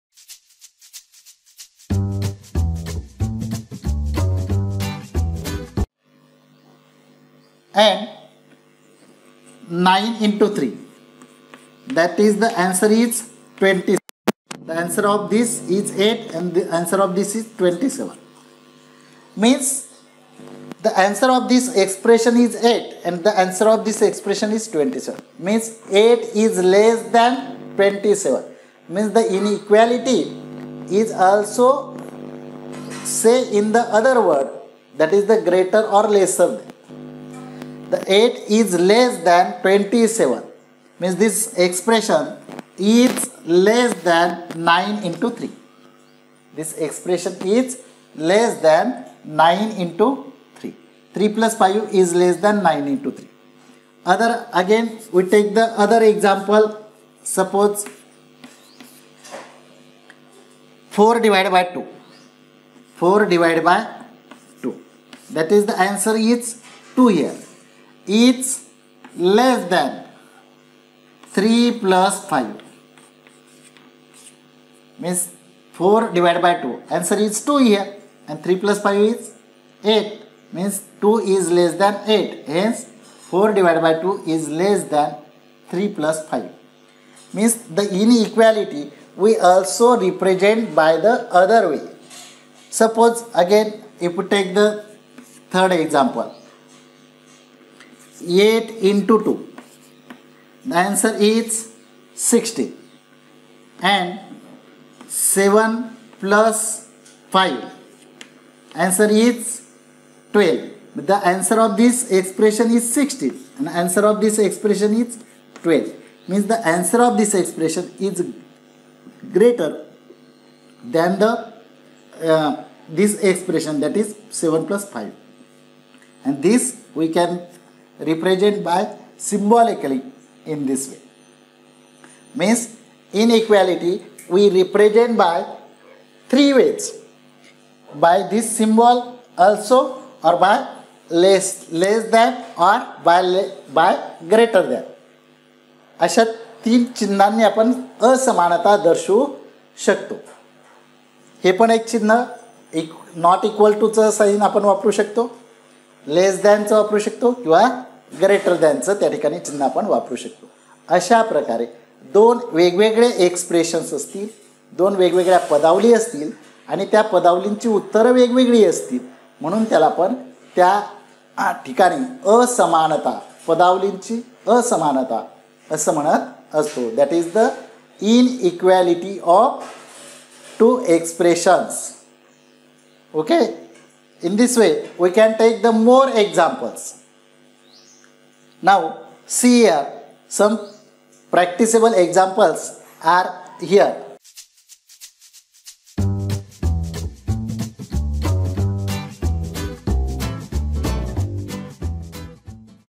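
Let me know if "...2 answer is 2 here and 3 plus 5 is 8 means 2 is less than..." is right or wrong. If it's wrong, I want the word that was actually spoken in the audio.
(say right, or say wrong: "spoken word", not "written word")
right.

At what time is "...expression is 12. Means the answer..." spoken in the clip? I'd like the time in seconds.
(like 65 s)
114 s.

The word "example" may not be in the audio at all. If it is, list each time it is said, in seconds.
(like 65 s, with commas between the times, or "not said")
56 s, 95 s, 191 s.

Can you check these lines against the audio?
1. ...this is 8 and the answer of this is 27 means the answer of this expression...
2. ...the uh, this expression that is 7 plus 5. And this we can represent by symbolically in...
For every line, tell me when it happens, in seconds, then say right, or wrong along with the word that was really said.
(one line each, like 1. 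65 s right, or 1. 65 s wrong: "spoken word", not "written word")
1. 15 s right
2. 121 s right.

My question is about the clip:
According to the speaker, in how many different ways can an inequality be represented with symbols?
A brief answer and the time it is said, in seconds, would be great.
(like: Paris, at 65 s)
3, at 136 s.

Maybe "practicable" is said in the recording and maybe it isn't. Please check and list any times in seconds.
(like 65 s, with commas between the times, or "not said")
191 s.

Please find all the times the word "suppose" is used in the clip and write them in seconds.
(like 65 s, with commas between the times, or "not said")
57 s, 92 s.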